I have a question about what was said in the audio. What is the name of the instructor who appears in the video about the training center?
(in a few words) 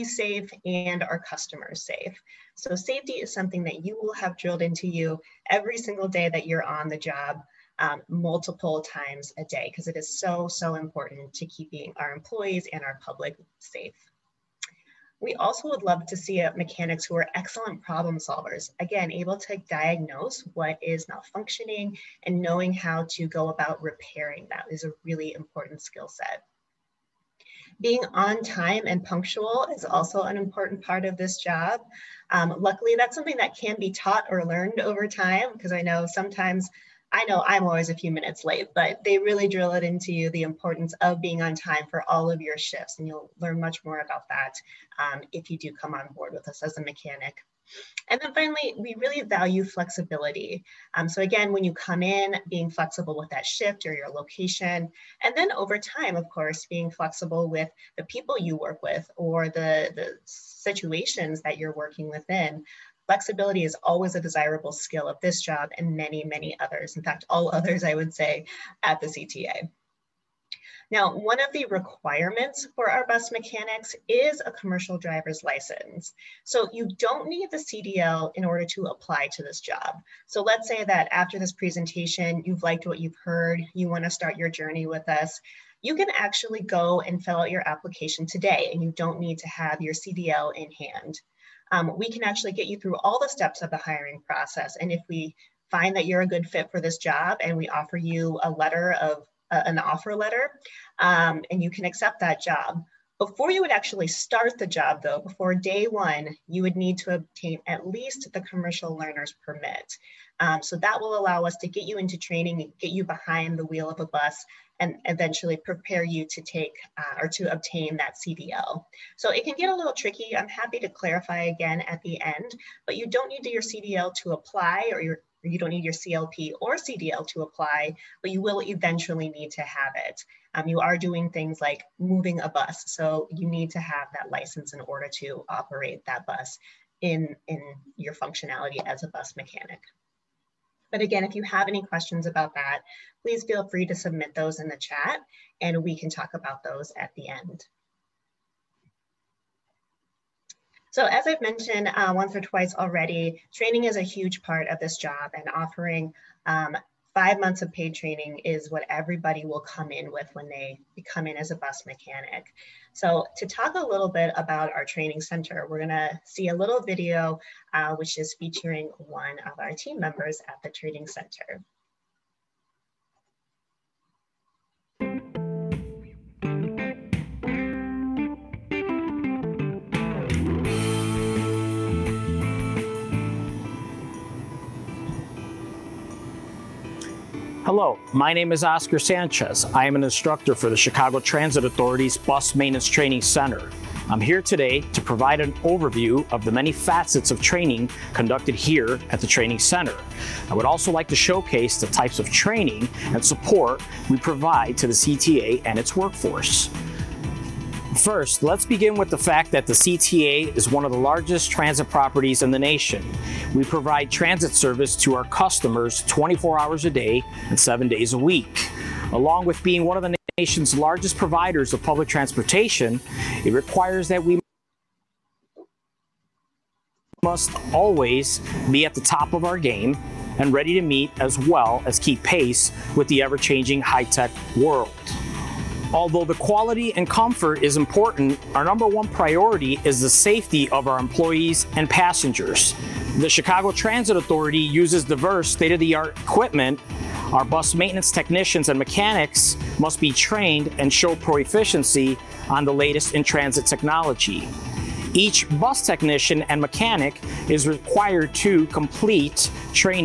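Oscar Sanchez.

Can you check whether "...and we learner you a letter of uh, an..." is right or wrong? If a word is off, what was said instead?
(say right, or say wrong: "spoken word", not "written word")
wrong: "offer", not "learner".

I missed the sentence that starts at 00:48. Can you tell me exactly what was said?
And then finally, we really value flexibility.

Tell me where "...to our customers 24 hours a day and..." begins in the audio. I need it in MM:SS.
03:34.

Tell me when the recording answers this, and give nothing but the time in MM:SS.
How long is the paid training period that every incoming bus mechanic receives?
02:37.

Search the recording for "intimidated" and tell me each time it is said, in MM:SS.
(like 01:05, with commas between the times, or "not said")
not said.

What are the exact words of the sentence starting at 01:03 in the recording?
Flexibility is always a desirable skill of this job and many, many others.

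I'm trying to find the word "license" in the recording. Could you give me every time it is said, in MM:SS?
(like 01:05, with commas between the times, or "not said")
01:15, 02:14.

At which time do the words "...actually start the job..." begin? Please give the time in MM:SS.
01:43.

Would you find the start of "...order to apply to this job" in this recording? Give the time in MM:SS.
01:18.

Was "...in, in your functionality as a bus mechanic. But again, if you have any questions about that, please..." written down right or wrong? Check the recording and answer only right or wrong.
right.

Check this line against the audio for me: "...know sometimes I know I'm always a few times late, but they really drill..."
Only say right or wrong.
wrong.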